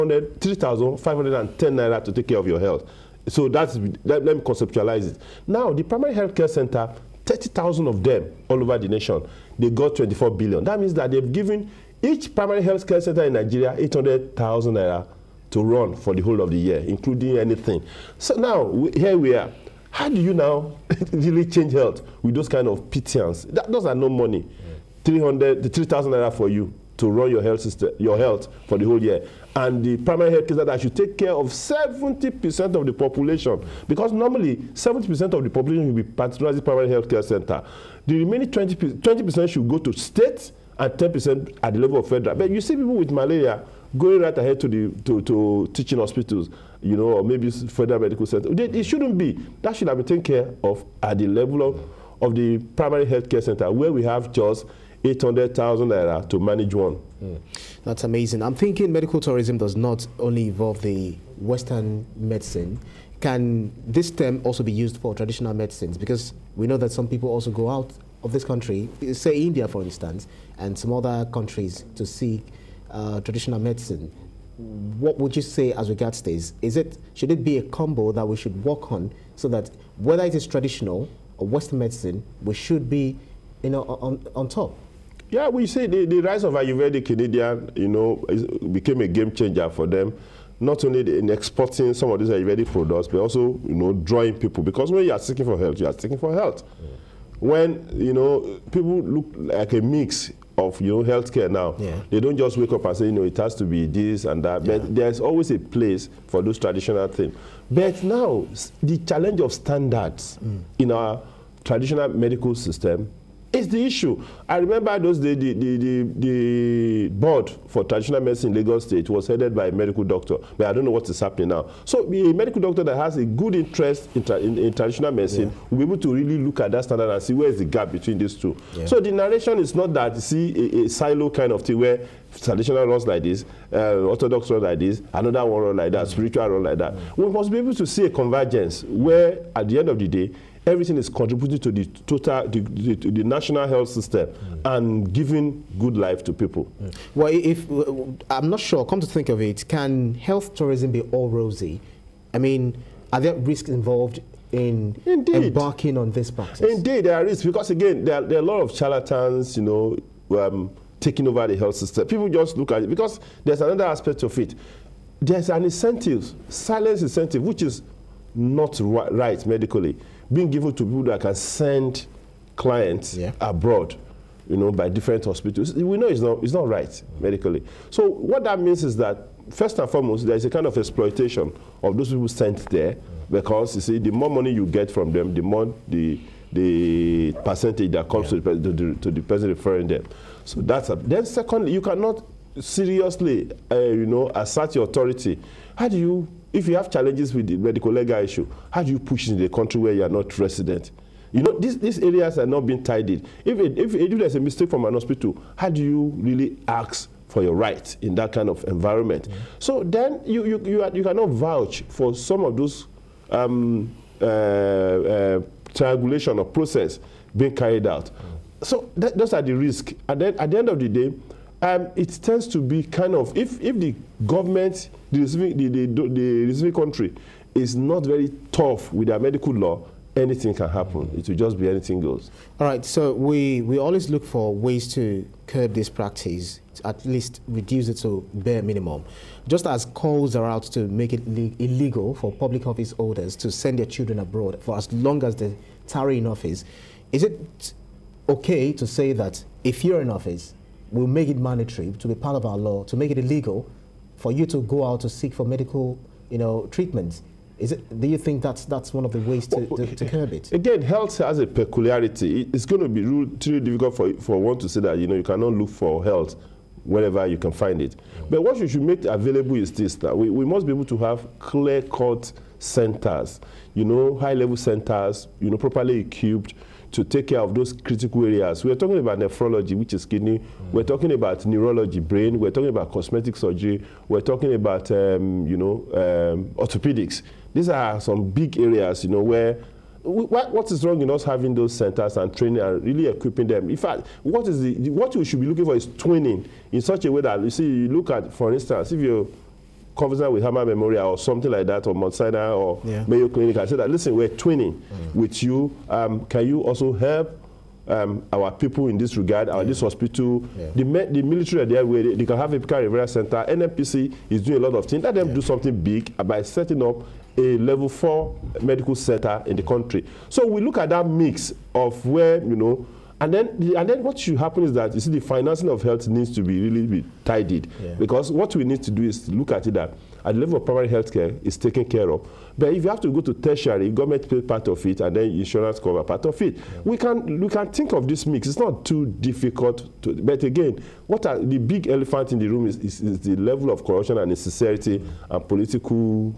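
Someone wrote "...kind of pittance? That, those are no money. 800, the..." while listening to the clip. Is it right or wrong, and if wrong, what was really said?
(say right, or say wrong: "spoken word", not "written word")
wrong: "300", not "800".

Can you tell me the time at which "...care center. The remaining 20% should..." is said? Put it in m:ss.
0:37.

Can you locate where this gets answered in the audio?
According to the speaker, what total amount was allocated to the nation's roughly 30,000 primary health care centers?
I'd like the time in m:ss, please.
0:09.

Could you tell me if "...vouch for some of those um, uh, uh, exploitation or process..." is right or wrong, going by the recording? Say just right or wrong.
wrong.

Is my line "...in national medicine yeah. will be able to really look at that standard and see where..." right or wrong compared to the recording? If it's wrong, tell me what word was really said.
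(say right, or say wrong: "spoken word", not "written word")
wrong: "traditional", not "national".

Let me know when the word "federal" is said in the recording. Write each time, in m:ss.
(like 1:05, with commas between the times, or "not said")
0:42, 0:47.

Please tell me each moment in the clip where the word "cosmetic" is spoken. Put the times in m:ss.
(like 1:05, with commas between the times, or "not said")
4:42.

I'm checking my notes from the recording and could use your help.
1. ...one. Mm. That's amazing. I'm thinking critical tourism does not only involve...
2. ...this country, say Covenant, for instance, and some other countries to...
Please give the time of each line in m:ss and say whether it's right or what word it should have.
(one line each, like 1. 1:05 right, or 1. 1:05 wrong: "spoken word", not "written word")
1. 0:56 wrong: "medical", not "critical"
2. 1:08 wrong: "India", not "Covenant".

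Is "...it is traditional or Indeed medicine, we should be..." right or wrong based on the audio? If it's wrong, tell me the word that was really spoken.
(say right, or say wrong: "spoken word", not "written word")
wrong: "Western", not "Indeed".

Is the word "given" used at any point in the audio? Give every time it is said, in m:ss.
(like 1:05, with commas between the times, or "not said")
0:11, 2:50.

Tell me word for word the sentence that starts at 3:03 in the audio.
because, you see, the more money you get from them, the more the, the percentage that comes yeah.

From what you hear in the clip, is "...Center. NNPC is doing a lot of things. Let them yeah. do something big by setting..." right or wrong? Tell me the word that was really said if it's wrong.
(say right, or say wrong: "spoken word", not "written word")
right.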